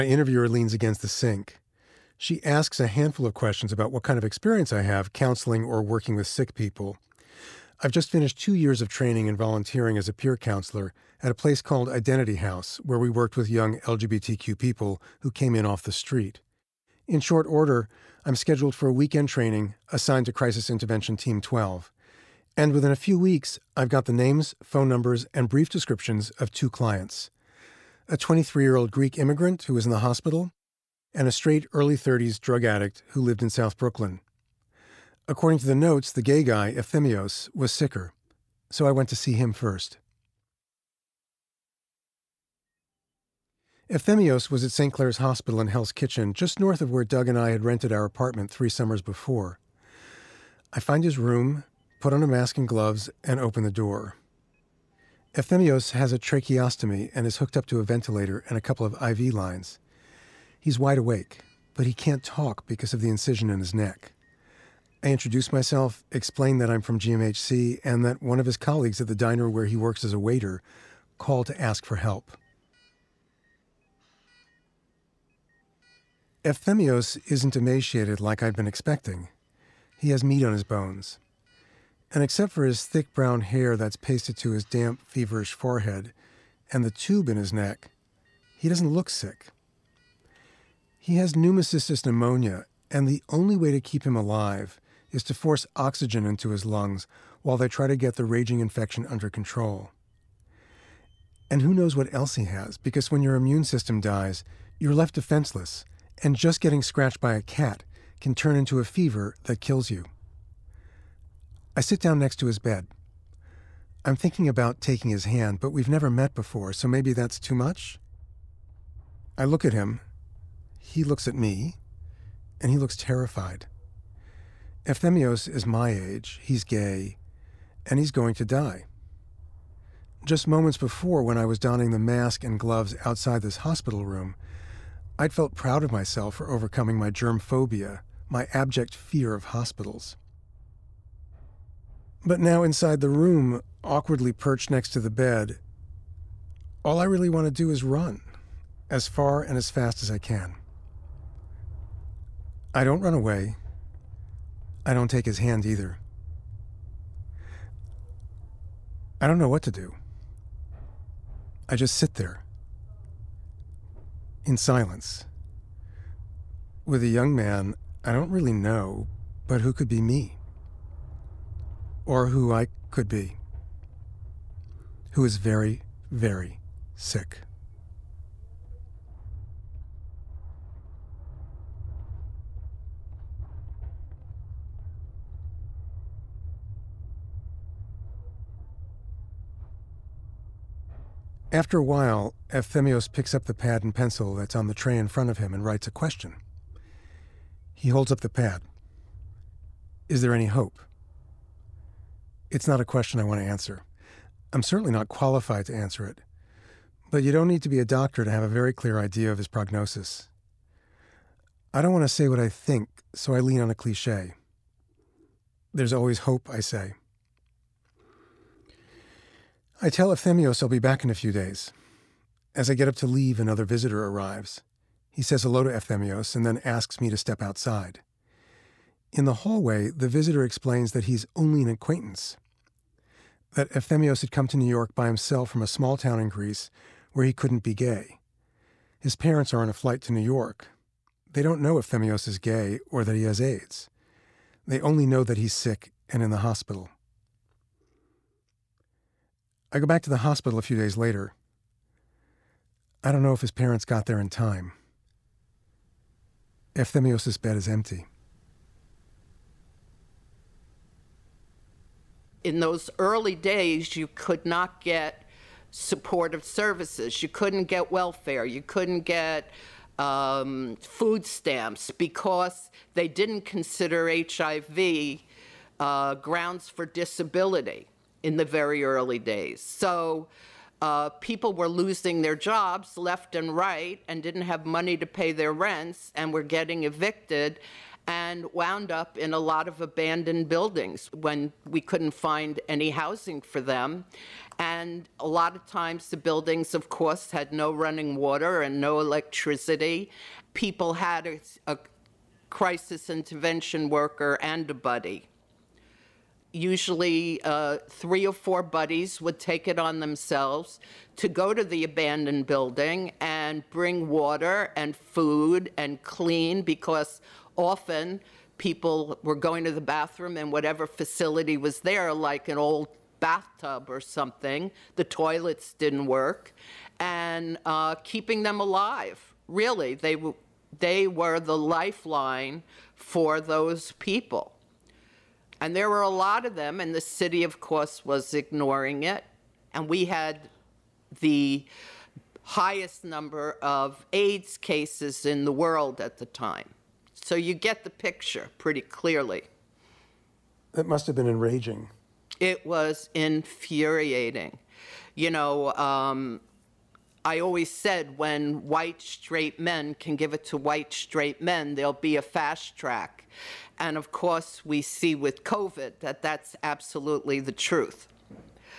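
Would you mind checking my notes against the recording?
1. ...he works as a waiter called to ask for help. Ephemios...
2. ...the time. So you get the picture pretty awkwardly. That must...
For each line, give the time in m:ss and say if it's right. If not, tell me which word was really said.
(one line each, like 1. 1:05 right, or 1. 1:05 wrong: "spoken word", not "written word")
1. 1:09 right
2. 5:46 wrong: "clearly", not "awkwardly".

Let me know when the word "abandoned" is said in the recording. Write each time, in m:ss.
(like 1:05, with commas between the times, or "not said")
4:49, 5:11.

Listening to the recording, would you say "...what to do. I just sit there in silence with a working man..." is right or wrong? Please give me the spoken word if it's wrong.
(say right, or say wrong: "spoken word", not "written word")
wrong: "young", not "working".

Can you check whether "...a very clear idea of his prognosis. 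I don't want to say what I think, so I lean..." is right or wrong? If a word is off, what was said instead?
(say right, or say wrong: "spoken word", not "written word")
right.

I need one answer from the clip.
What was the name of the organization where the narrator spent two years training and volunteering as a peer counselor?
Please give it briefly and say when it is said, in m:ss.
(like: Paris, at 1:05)
Identity House, at 0:11.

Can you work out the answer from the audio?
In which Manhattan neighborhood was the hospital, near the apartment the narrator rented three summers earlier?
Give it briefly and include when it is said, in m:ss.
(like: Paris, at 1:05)
Hell's Kitchen, at 0:45.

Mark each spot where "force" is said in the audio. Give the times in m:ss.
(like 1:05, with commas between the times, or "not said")
1:35.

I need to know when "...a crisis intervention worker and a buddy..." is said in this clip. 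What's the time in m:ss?
5:01.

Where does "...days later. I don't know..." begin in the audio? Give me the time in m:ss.
4:10.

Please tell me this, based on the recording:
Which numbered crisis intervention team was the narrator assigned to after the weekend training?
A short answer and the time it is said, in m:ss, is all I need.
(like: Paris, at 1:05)
12, at 0:20.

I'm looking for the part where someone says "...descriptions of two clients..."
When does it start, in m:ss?
0:25.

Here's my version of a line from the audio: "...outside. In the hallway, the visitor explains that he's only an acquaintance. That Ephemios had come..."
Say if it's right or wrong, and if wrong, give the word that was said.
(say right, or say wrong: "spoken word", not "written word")
right.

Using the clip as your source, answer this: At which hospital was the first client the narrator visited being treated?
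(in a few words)
St. Clare's Hospital.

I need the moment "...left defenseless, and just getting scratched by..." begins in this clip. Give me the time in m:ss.
1:44.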